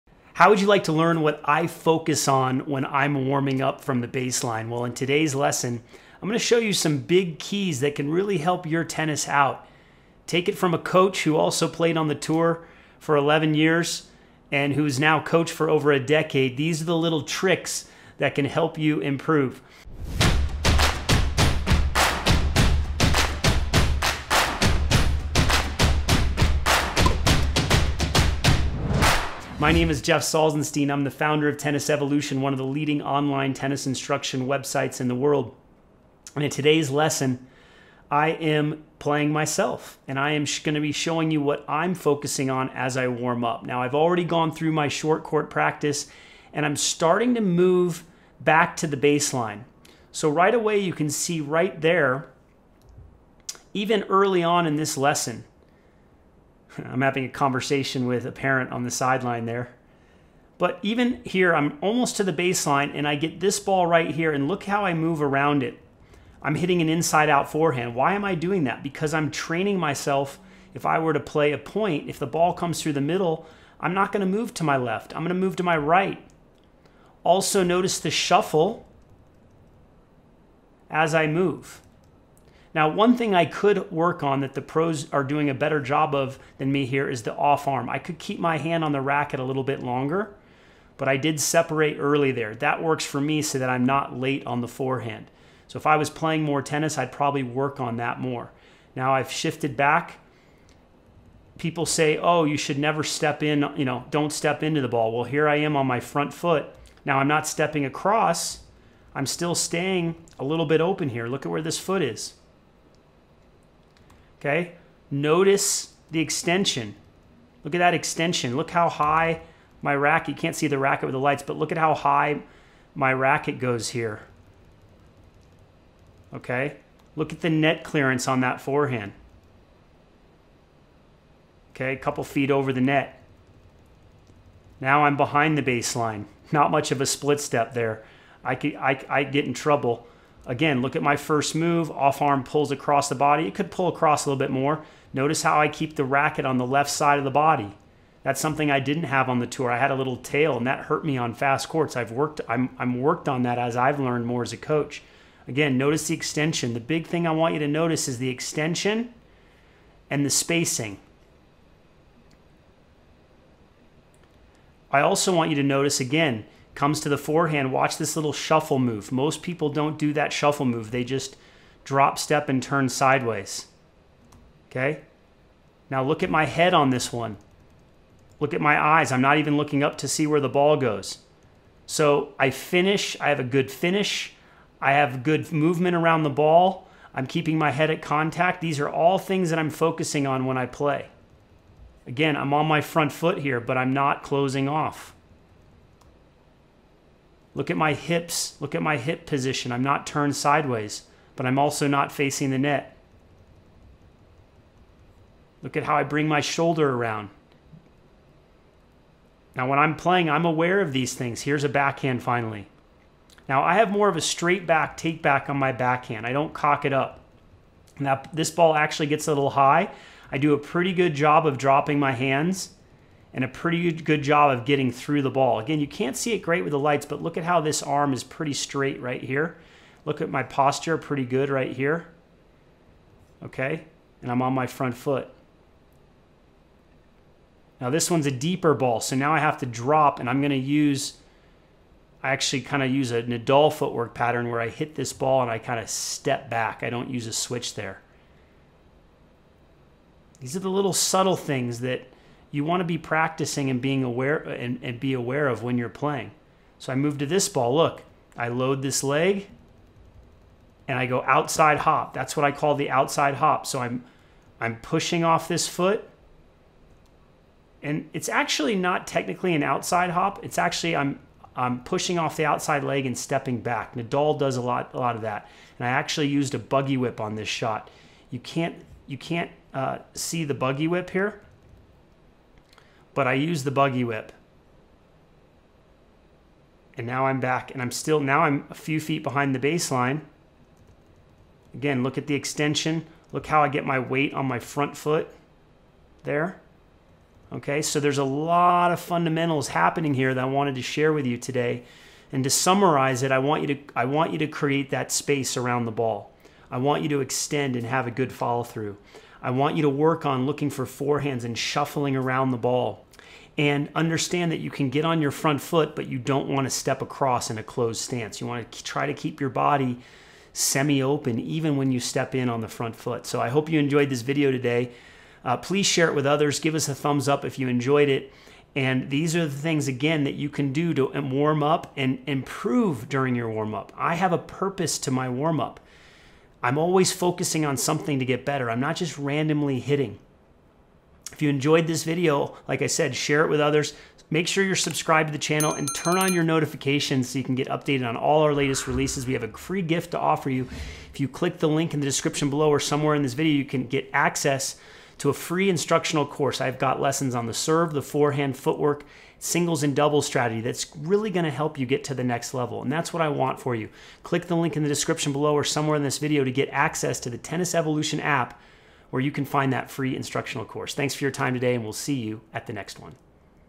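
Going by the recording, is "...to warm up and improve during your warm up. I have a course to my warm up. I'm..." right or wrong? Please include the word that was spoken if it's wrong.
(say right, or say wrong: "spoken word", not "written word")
wrong: "purpose", not "course".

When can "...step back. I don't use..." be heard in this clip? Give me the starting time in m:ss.
4:05.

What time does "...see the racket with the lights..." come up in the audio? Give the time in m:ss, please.
2:00.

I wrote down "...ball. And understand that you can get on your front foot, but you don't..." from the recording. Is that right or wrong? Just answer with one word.
right.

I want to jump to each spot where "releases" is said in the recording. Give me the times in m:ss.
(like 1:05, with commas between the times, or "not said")
5:48.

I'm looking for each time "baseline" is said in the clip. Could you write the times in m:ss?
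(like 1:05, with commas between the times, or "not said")
0:04, 0:48, 1:02, 2:15, 4:49.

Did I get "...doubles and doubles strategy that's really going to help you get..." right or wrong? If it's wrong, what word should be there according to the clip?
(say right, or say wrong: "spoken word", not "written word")
wrong: "singles", not "doubles".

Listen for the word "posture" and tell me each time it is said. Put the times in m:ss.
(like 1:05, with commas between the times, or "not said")
3:50.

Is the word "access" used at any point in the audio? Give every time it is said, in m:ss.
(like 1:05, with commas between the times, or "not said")
5:54, 6:06.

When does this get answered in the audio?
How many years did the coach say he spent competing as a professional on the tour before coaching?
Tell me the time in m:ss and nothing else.
0:13.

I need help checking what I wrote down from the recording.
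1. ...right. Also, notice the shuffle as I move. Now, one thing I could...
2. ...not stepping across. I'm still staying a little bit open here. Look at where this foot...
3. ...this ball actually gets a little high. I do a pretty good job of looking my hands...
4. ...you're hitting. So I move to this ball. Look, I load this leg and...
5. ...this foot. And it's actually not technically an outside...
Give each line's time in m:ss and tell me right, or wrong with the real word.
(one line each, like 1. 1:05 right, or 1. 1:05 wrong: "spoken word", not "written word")
1. 1:15 right
2. 1:47 right
3. 3:38 wrong: "dropping", not "looking"
4. 4:15 wrong: "playing", not "hitting"
5. 4:25 right.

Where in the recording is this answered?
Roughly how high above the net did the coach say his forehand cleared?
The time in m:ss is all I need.
2:11.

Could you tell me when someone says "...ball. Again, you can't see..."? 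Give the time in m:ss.
3:45.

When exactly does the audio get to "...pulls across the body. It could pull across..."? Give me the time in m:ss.
2:22.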